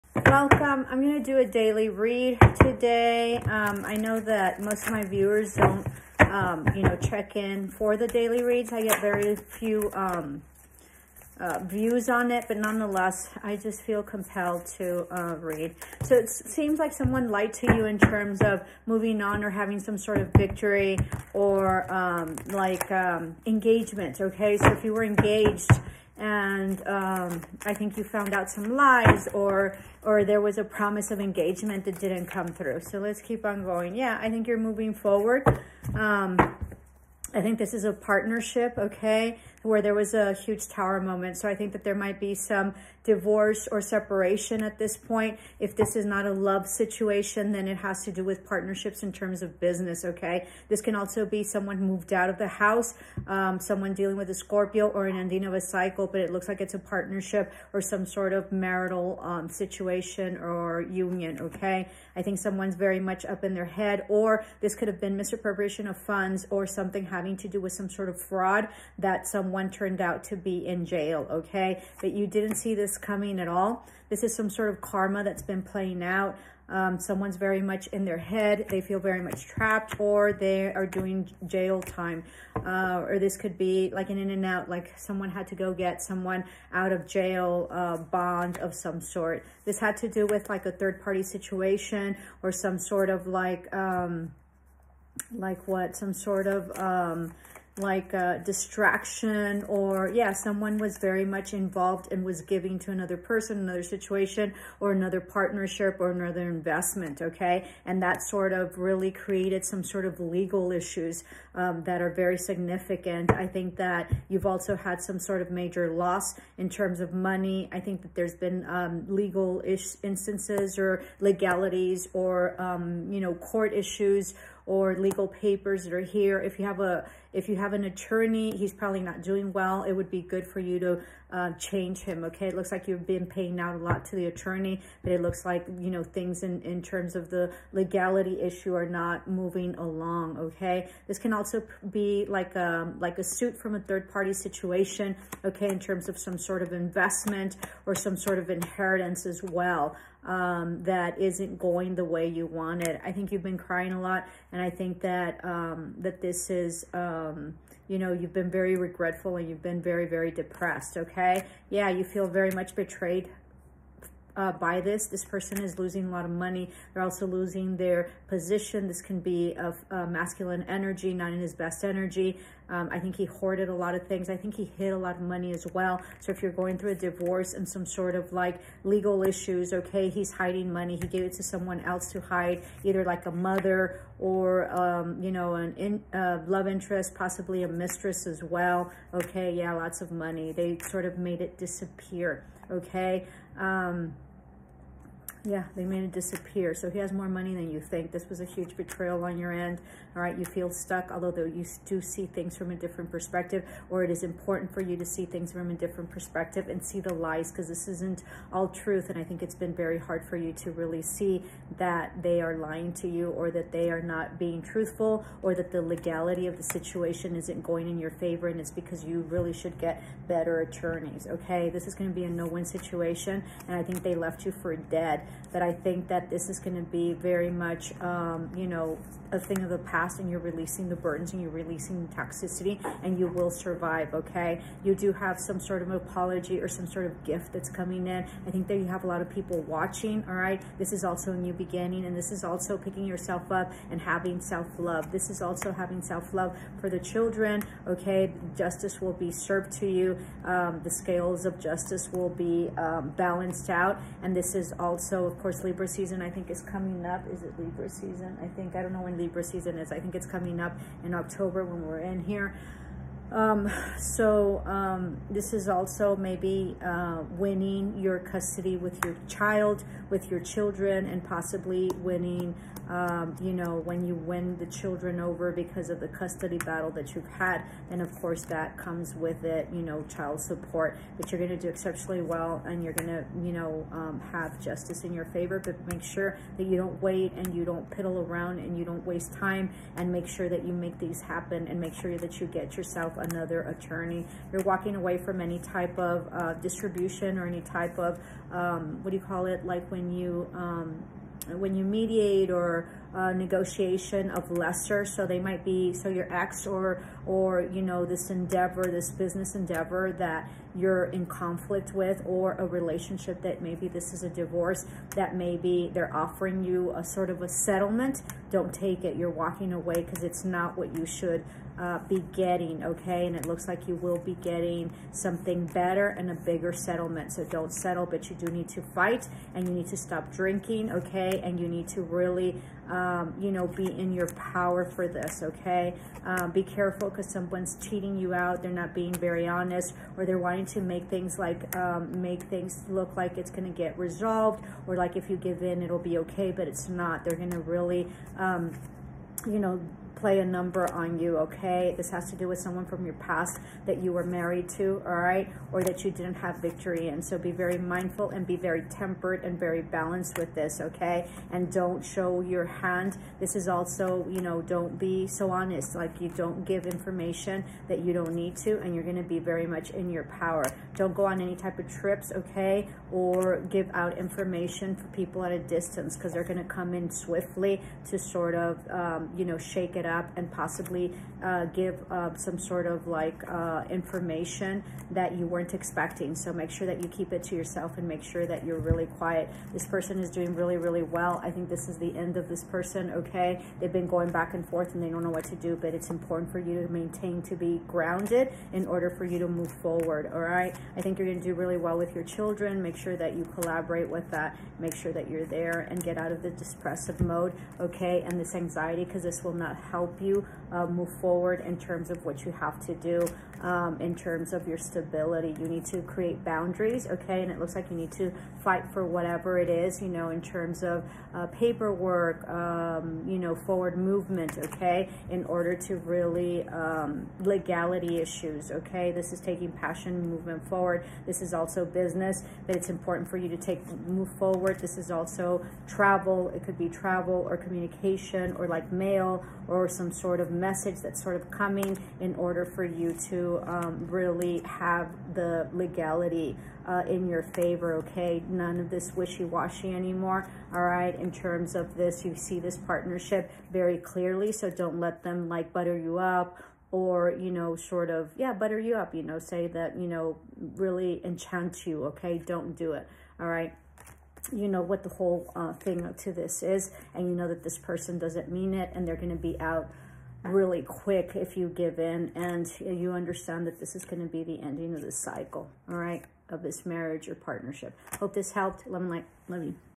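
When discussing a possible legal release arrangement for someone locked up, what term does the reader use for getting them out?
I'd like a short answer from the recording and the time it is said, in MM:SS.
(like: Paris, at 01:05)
bond, at 01:27.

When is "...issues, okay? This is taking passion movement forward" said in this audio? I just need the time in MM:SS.
07:08.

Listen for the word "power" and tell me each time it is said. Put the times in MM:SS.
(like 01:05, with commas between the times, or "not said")
05:34, 06:10.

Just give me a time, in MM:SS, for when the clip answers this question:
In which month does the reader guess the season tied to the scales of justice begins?
04:21.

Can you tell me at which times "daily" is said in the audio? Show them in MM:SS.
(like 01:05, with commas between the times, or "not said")
00:01, 00:08.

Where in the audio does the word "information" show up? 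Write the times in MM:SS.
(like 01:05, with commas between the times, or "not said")
06:06, 06:14, 06:23.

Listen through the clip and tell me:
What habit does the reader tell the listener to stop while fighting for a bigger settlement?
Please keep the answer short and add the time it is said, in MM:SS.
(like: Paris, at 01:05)
drinking, at 05:30.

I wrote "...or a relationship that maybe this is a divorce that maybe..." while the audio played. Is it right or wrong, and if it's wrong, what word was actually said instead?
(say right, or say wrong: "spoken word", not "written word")
right.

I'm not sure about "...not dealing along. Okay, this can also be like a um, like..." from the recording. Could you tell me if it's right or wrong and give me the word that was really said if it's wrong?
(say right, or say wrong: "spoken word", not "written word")
wrong: "moving", not "dealing".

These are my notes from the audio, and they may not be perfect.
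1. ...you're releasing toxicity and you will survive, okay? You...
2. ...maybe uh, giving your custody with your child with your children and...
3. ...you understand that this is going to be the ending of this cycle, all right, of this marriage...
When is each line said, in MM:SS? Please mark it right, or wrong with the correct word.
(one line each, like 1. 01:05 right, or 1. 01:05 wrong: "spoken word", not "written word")
1. 03:51 right
2. 04:26 wrong: "winning", not "giving"
3. 07:52 right.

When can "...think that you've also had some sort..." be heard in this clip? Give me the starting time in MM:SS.
01:53.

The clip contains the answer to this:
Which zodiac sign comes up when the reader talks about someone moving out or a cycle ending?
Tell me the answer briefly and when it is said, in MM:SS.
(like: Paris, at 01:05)
Scorpio, at 00:54.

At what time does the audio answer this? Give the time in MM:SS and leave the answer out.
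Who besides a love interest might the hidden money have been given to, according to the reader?
03:03.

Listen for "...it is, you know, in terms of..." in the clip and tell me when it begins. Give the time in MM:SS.
06:59.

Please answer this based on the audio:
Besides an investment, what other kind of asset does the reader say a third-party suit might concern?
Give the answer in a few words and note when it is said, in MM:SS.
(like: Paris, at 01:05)
inheritance, at 02:28.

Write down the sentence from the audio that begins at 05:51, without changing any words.
This has to do with someone from your past that you were married to, all right?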